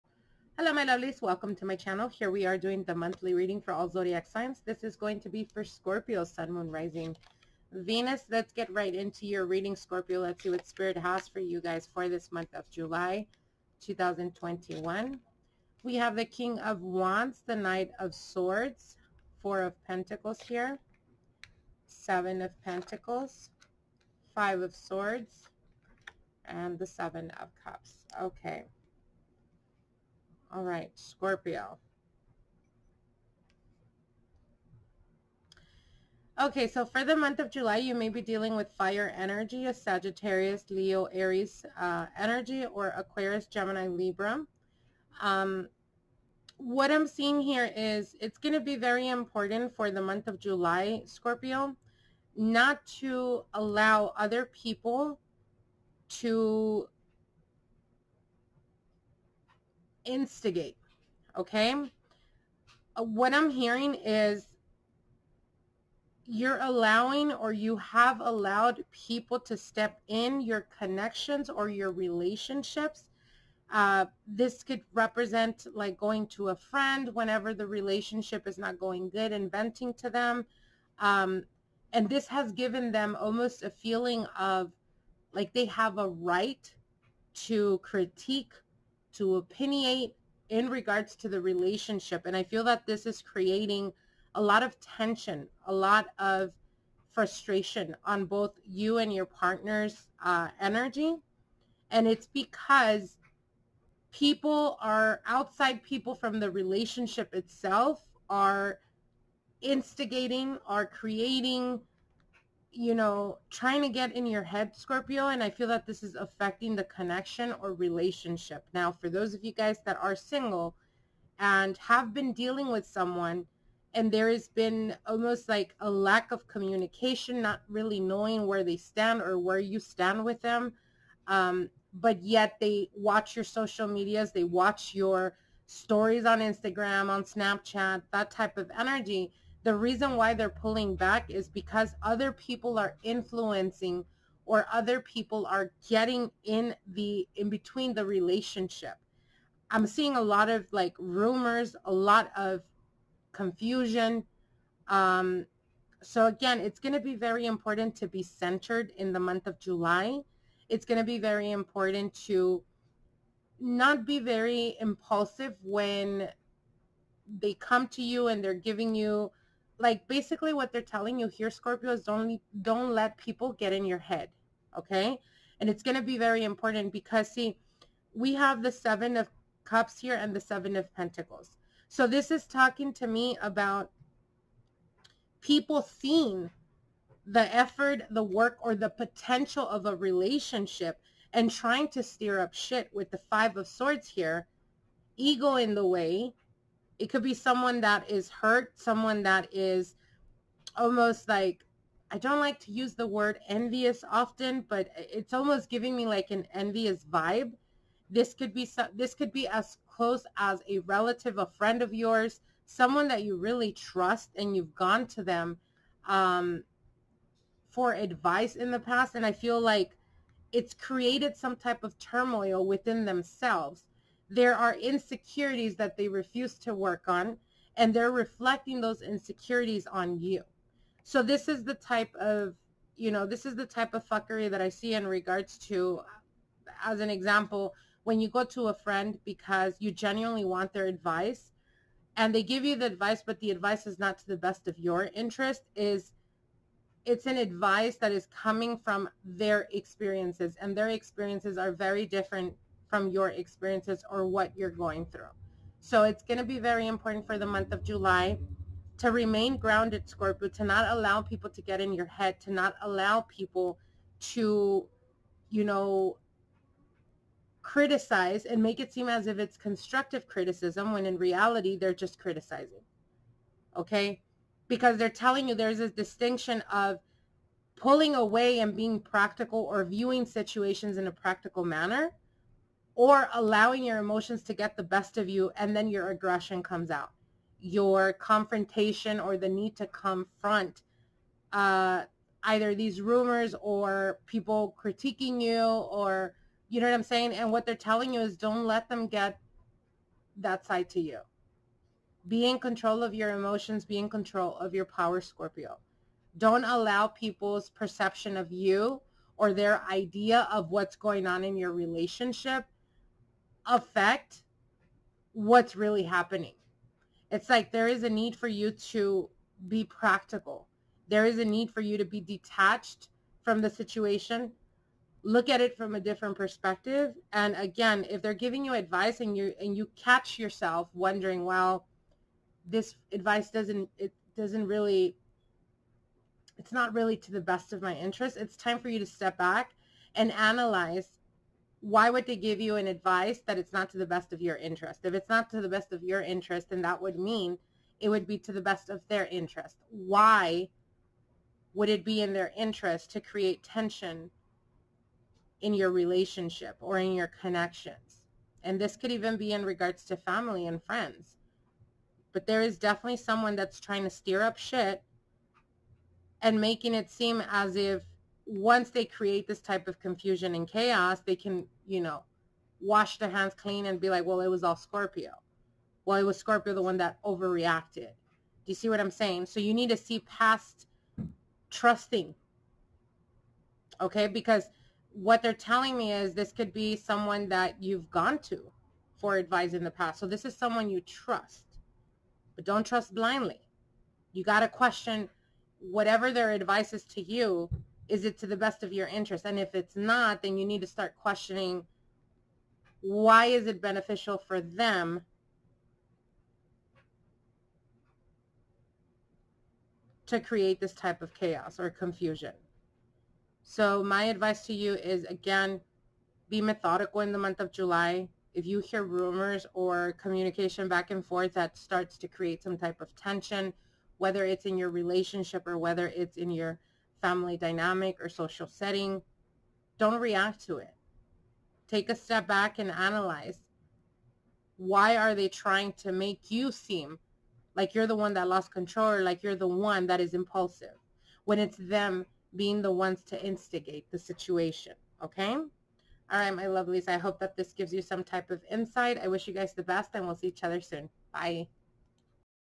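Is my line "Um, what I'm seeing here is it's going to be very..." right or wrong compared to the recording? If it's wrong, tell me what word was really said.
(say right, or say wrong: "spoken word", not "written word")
right.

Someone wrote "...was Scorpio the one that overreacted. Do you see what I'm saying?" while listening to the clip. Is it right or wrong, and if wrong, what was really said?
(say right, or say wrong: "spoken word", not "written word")
right.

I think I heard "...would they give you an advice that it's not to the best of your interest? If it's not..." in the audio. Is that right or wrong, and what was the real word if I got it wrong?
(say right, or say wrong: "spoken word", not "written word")
right.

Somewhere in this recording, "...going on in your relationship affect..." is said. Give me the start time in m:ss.
5:10.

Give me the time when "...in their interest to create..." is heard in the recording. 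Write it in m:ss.
5:52.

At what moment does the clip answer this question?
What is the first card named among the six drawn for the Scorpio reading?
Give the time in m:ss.
0:16.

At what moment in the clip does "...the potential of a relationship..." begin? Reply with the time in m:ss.
3:08.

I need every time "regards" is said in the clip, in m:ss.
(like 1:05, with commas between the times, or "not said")
1:30, 3:55, 5:59.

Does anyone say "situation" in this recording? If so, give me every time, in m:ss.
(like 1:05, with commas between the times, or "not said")
4:40, 5:23, 7:24.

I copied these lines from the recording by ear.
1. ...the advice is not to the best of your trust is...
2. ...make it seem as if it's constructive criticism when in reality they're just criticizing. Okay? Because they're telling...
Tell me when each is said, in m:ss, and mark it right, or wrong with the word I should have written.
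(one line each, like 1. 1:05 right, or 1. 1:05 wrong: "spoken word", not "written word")
1. 4:03 wrong: "interest", not "trust"
2. 4:28 right.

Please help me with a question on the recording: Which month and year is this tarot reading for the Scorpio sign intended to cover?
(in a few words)
July 2021.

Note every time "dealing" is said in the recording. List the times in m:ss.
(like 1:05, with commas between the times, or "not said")
0:38, 2:02.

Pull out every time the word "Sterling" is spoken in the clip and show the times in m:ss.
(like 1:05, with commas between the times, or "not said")
not said.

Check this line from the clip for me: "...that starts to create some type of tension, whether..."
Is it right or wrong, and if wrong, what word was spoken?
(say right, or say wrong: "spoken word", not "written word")
right.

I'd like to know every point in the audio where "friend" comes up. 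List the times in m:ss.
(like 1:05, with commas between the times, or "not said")
1:16, 3:31, 3:58, 6:00.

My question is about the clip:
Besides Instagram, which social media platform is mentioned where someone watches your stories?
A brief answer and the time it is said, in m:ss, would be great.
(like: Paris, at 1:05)
Snapchat, at 2:17.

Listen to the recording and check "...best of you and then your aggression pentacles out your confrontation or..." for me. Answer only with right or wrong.
wrong.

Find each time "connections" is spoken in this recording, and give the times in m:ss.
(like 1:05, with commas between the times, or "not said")
1:10, 1:56, 5:57.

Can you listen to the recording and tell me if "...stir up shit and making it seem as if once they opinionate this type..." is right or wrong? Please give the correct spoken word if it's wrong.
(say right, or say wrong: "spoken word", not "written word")
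wrong: "create", not "opinionate".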